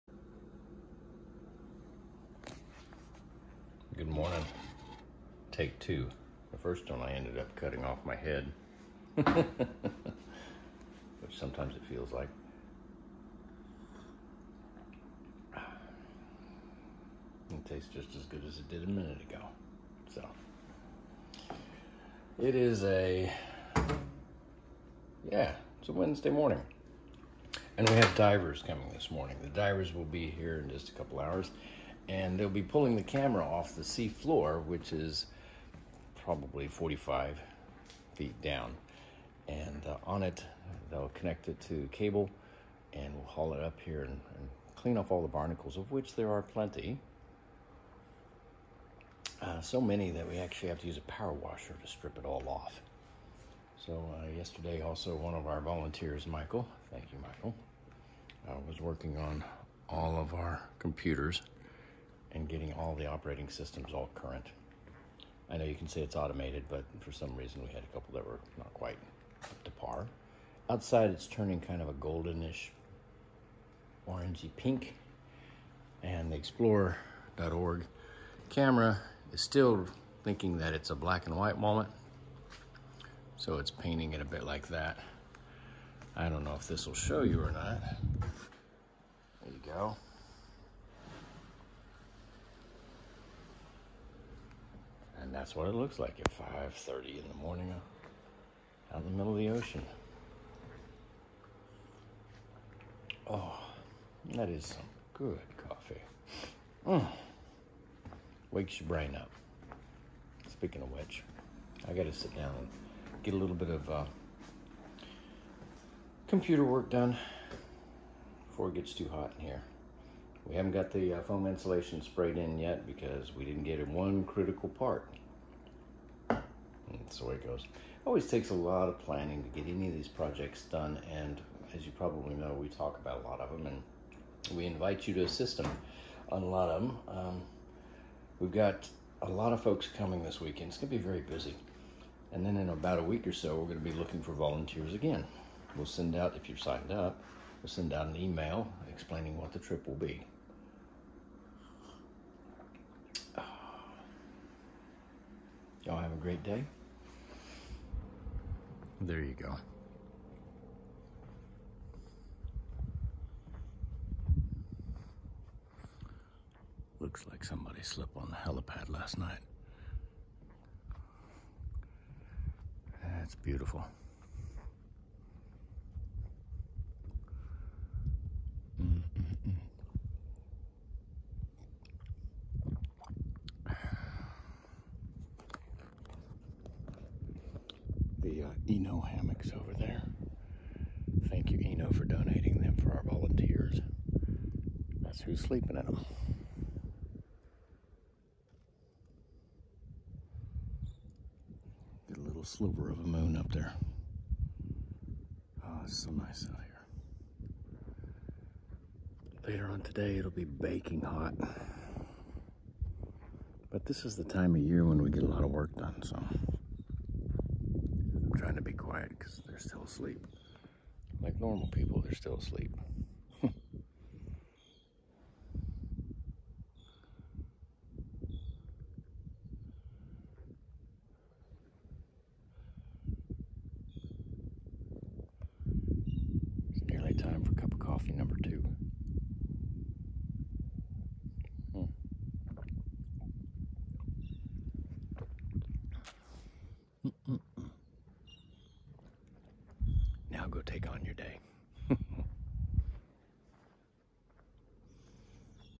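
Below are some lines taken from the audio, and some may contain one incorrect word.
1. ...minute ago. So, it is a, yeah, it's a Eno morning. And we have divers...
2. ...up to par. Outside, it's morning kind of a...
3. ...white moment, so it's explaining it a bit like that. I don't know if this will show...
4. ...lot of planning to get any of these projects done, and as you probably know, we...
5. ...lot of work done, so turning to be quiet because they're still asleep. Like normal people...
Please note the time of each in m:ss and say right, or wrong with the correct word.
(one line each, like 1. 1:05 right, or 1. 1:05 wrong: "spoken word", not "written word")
1. 0:18 wrong: "Wednesday", not "Eno"
2. 1:09 wrong: "turning", not "morning"
3. 1:21 wrong: "painting", not "explaining"
4. 2:08 right
5. 3:35 wrong: "trying", not "turning".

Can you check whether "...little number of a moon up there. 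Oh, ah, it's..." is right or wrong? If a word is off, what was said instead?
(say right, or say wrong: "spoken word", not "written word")
wrong: "sliver", not "number".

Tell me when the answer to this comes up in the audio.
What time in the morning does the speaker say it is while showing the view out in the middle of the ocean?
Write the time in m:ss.
1:36.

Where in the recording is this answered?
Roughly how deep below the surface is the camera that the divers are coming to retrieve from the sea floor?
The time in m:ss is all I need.
0:36.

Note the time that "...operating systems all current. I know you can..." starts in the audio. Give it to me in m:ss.
1:03.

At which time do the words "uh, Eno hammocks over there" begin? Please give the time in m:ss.
3:08.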